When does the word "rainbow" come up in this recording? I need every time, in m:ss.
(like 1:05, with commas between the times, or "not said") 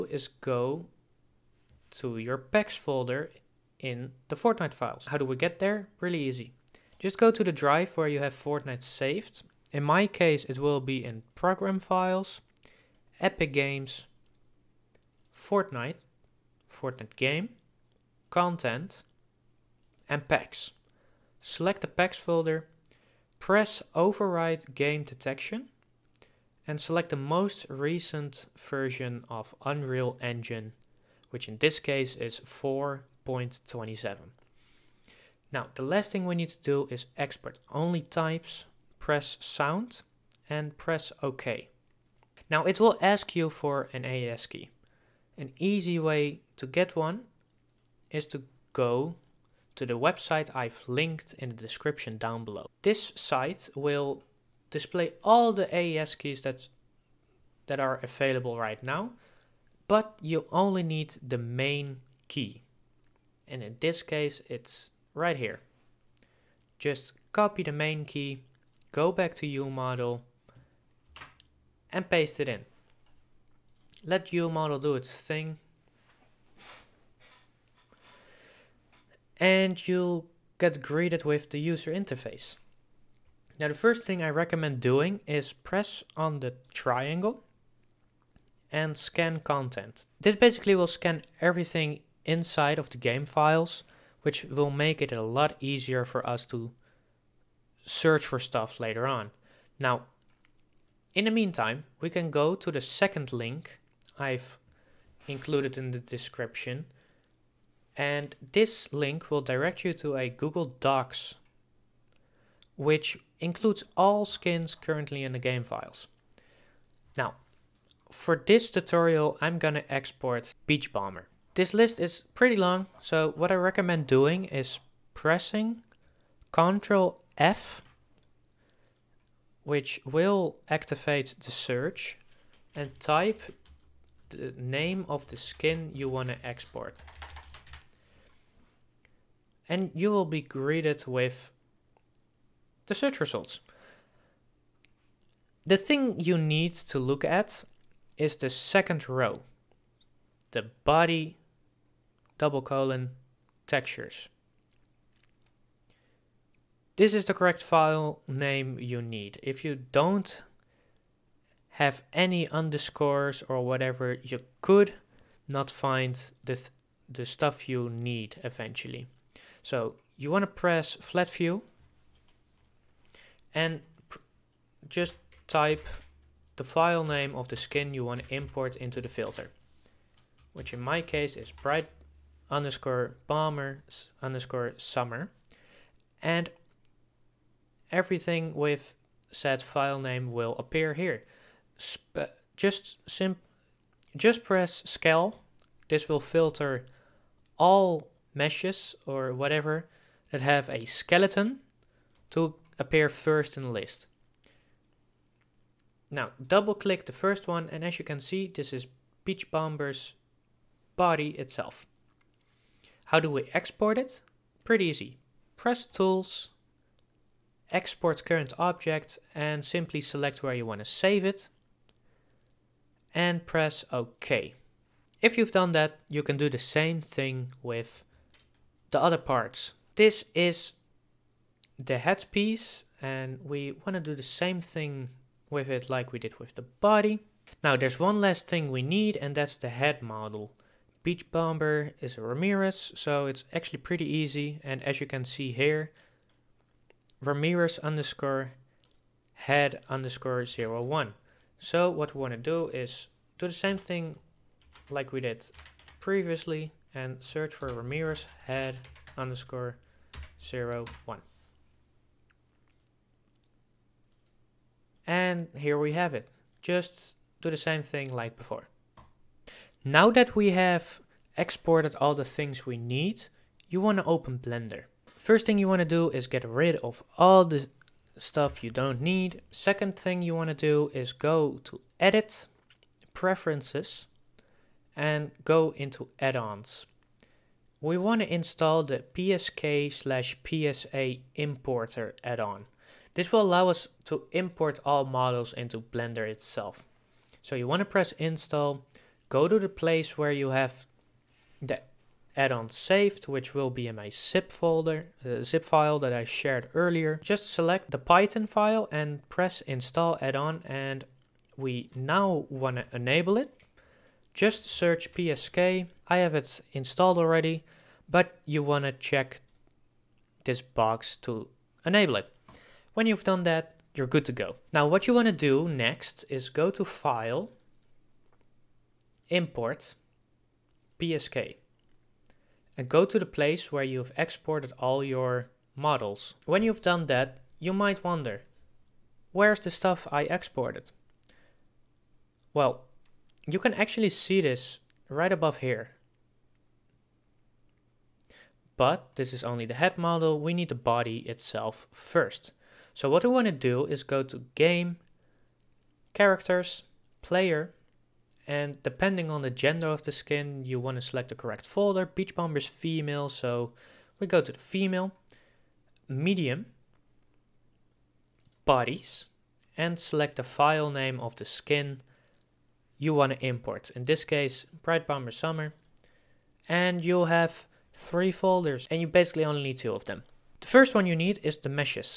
not said.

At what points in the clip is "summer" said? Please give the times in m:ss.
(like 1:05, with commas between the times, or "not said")
3:04, 6:15.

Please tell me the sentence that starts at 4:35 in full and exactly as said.
First thing you want to do is get rid of all the stuff you don't need.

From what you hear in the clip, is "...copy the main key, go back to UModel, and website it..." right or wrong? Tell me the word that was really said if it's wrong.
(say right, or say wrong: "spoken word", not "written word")
wrong: "paste", not "website".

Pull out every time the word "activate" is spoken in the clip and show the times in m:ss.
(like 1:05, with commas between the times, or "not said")
2:10.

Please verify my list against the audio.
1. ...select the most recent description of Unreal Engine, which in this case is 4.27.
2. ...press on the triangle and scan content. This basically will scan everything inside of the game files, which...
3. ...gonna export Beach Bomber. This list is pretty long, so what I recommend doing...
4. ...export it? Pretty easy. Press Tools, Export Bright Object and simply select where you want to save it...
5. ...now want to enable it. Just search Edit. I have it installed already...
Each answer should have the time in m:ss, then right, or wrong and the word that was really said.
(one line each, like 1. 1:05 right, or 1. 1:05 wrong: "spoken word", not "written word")
1. 0:26 wrong: "version", not "description"
2. 1:25 right
3. 1:59 right
4. 3:33 wrong: "Current", not "Bright"
5. 5:11 wrong: "PSK", not "Edit".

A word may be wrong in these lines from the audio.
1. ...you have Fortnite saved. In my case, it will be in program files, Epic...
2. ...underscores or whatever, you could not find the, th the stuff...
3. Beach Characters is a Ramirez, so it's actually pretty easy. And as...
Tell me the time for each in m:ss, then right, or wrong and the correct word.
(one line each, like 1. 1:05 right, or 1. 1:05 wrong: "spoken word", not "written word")
1. 0:08 right
2. 2:42 right
3. 4:01 wrong: "Bomber", not "Characters".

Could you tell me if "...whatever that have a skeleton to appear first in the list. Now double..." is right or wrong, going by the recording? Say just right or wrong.
right.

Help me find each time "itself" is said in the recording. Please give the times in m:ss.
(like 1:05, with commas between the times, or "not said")
3:31, 4:56, 5:51.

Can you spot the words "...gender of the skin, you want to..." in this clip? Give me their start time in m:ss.
5:59.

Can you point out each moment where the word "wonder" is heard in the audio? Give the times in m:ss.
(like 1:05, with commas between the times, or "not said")
5:38.